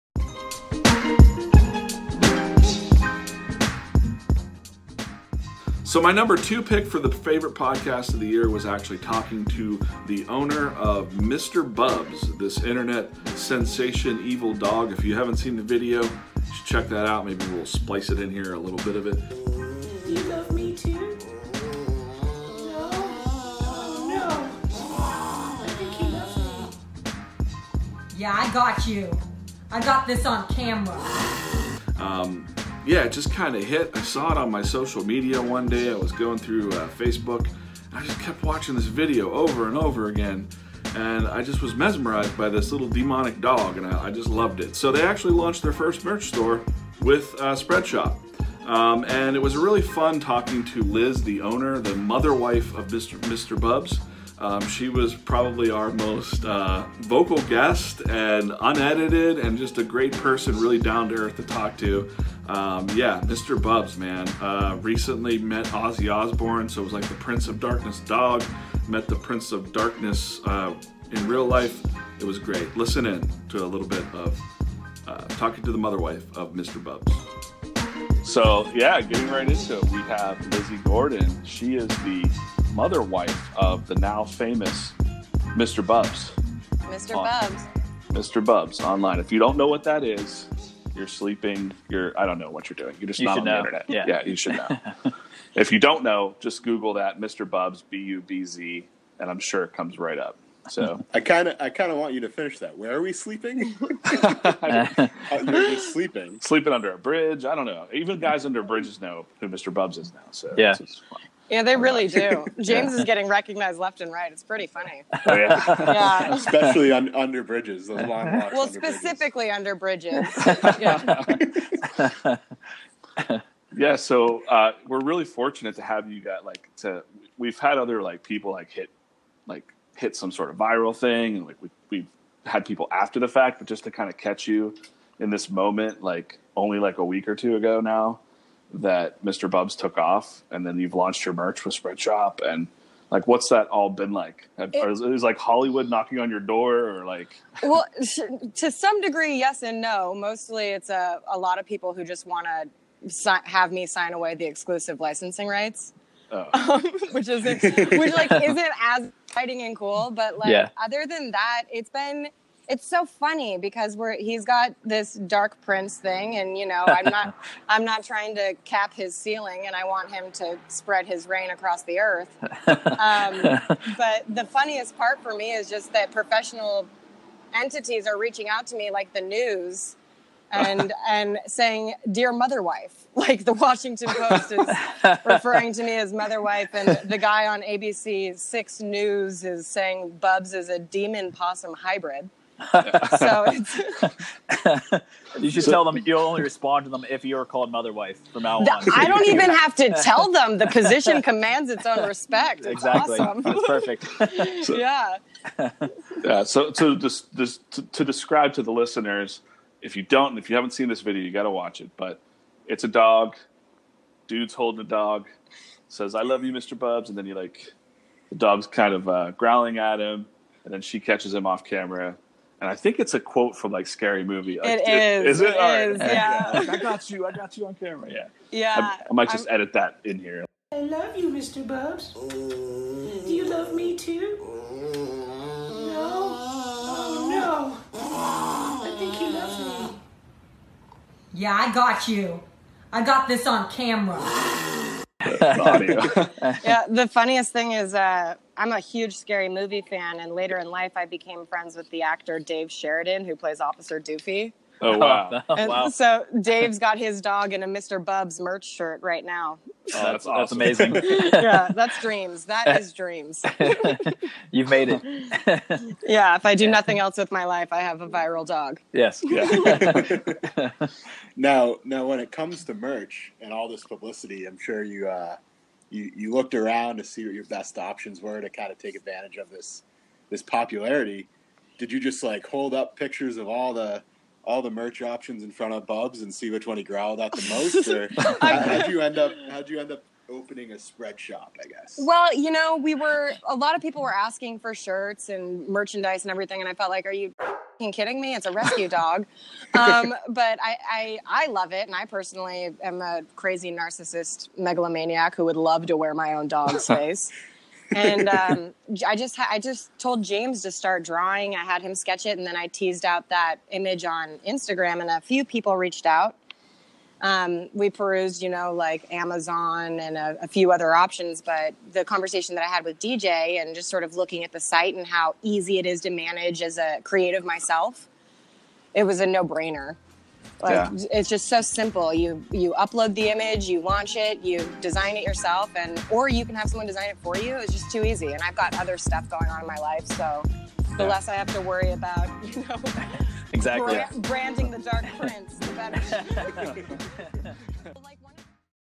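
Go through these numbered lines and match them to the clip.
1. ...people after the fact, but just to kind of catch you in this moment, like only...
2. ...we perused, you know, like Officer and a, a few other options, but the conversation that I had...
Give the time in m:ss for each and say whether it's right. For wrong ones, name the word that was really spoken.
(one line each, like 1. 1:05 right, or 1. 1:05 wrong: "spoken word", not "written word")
1. 2:12 right
2. 5:17 wrong: "Amazon", not "Officer".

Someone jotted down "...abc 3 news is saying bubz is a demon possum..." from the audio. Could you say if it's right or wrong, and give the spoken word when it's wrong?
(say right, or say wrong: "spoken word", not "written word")
wrong: "6", not "3".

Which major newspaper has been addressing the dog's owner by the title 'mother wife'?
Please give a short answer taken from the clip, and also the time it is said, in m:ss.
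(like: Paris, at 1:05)
The Washington Post, at 3:03.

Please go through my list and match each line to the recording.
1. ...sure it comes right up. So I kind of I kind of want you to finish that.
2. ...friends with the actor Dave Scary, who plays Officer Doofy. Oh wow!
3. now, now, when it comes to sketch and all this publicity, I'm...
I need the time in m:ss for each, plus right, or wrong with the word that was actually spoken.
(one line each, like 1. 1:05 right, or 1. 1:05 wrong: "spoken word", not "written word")
1. 1:39 right
2. 4:11 wrong: "Sheridan", not "Scary"
3. 4:31 wrong: "merch", not "sketch".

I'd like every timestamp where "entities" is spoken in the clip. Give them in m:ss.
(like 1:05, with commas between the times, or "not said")
2:57.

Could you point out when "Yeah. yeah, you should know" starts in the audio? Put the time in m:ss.
1:33.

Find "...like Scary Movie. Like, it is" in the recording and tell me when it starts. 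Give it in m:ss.
3:43.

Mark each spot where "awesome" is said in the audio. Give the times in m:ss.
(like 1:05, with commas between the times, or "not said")
3:23, 4:20.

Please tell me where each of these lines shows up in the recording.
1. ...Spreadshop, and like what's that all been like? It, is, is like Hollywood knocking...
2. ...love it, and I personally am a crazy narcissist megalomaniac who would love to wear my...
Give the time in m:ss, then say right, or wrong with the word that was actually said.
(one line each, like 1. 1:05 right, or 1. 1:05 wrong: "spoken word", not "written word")
1. 2:21 right
2. 5:01 right.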